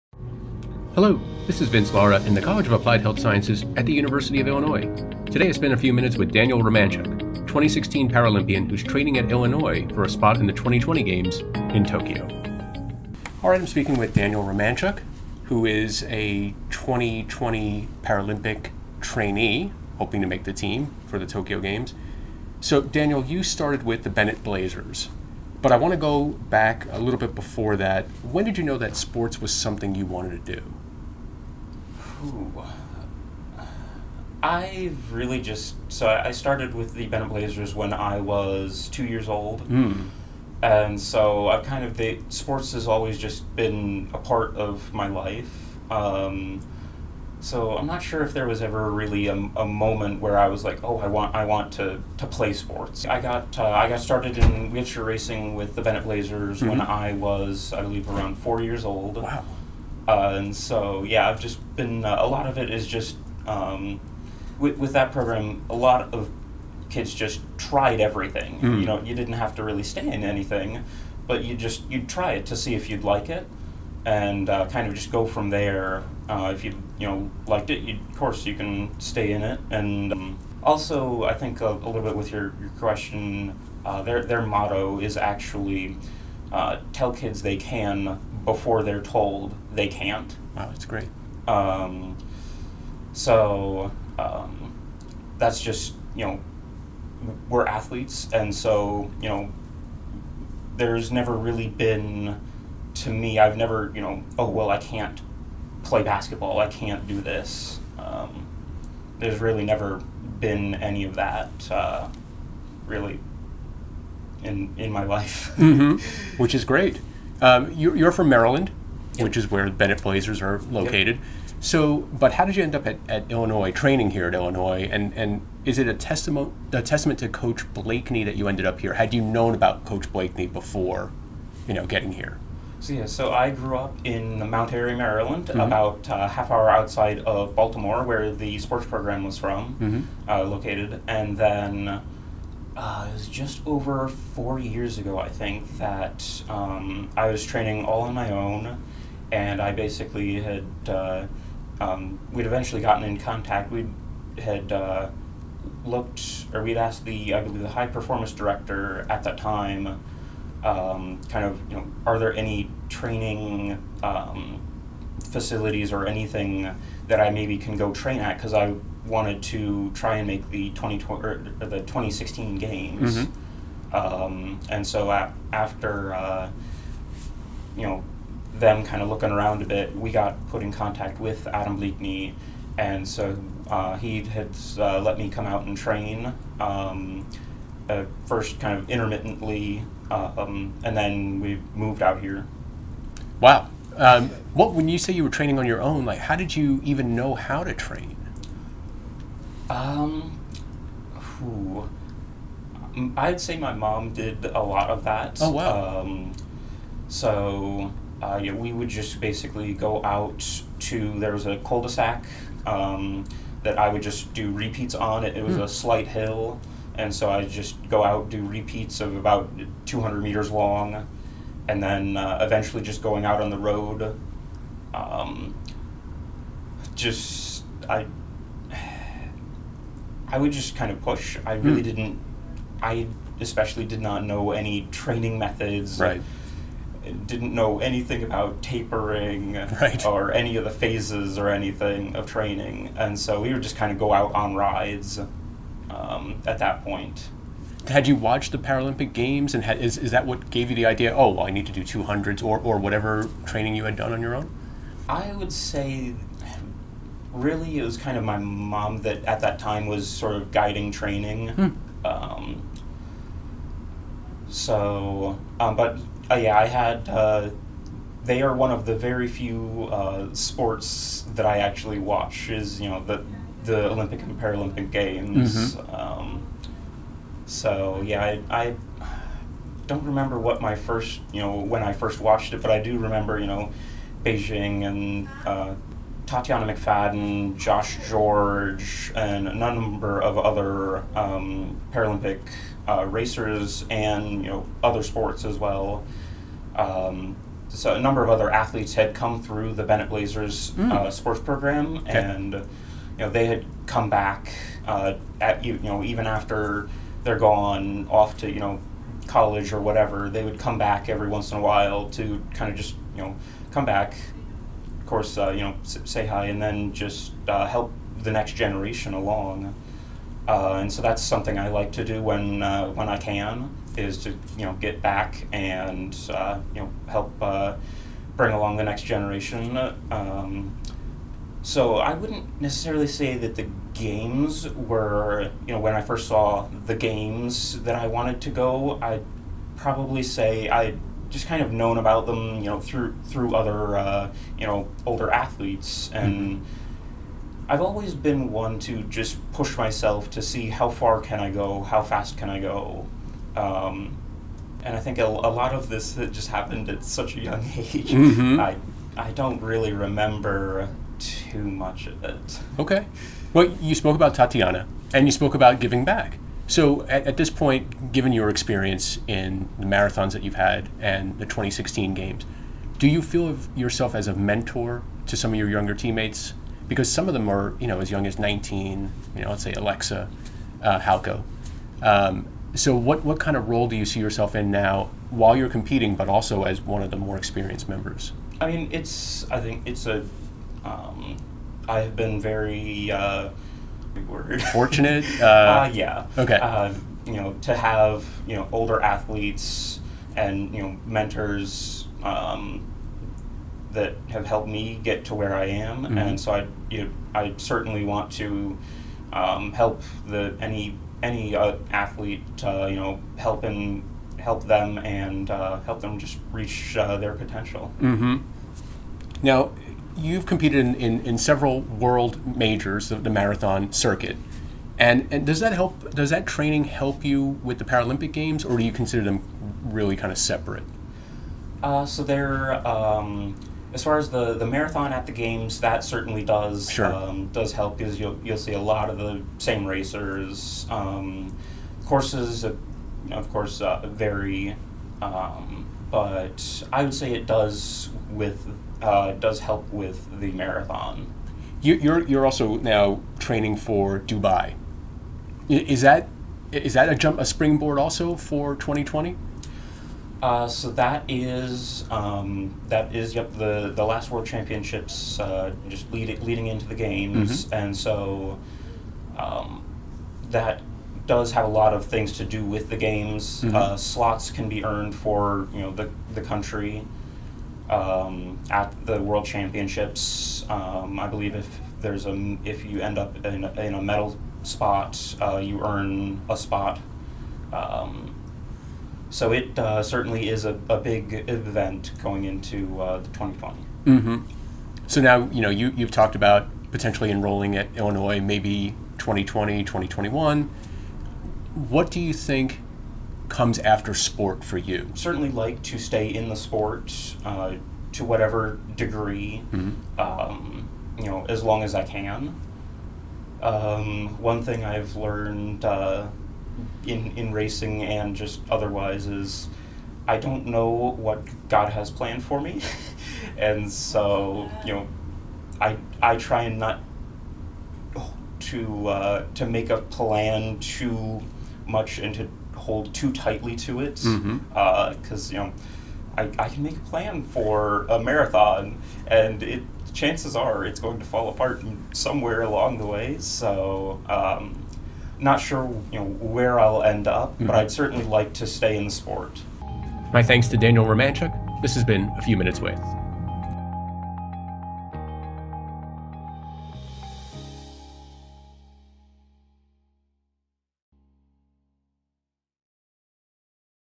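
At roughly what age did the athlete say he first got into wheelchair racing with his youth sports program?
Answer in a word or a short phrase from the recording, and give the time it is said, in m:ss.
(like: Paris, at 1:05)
4, at 0:58.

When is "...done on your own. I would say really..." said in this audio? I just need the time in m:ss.
4:13.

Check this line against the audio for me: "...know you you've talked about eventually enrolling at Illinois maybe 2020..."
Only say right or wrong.
wrong.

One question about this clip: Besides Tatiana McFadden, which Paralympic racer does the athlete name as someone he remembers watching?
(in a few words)
Josh George.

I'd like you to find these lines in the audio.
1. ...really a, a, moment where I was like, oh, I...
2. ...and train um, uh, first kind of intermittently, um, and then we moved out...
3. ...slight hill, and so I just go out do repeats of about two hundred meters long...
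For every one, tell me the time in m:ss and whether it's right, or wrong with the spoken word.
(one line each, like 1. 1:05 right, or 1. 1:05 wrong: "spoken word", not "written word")
1. 0:48 right
2. 3:05 right
3. 3:35 right.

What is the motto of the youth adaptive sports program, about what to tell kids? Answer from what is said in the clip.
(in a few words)
Tell kids they can before they're told they can't.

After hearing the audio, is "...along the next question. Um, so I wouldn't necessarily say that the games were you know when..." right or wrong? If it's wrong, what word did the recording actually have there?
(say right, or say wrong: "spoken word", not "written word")
wrong: "generation", not "question".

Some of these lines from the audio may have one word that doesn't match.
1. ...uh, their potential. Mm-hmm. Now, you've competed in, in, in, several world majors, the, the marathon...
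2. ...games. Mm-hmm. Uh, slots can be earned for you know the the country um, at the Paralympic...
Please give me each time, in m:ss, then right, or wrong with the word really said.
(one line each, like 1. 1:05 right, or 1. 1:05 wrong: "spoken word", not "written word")
1. 6:56 right
2. 7:52 wrong: "World", not "Paralympic".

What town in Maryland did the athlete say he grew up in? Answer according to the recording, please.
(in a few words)
Mount Airy.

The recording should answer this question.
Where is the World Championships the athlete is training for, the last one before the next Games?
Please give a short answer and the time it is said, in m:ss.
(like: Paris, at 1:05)
Dubai, at 7:34.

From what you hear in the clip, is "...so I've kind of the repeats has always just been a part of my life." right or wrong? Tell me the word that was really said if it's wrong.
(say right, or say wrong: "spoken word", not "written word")
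wrong: "sports", not "repeats".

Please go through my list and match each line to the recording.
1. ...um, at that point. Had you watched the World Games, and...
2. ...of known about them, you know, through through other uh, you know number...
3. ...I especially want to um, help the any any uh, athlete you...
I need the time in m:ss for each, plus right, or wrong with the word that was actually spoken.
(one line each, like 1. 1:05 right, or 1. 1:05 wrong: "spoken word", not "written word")
1. 4:05 wrong: "Paralympic", not "World"
2. 5:41 wrong: "older", not "number"
3. 6:47 wrong: "certainly", not "especially".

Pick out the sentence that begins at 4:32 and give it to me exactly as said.
Is you know the the Olympic and Paralympic Games.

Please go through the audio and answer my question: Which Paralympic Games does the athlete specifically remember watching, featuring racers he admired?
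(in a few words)
Beijing.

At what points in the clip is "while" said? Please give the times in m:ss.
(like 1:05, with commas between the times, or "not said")
5:11, 6:25.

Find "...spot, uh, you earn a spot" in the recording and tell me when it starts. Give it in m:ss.
8:04.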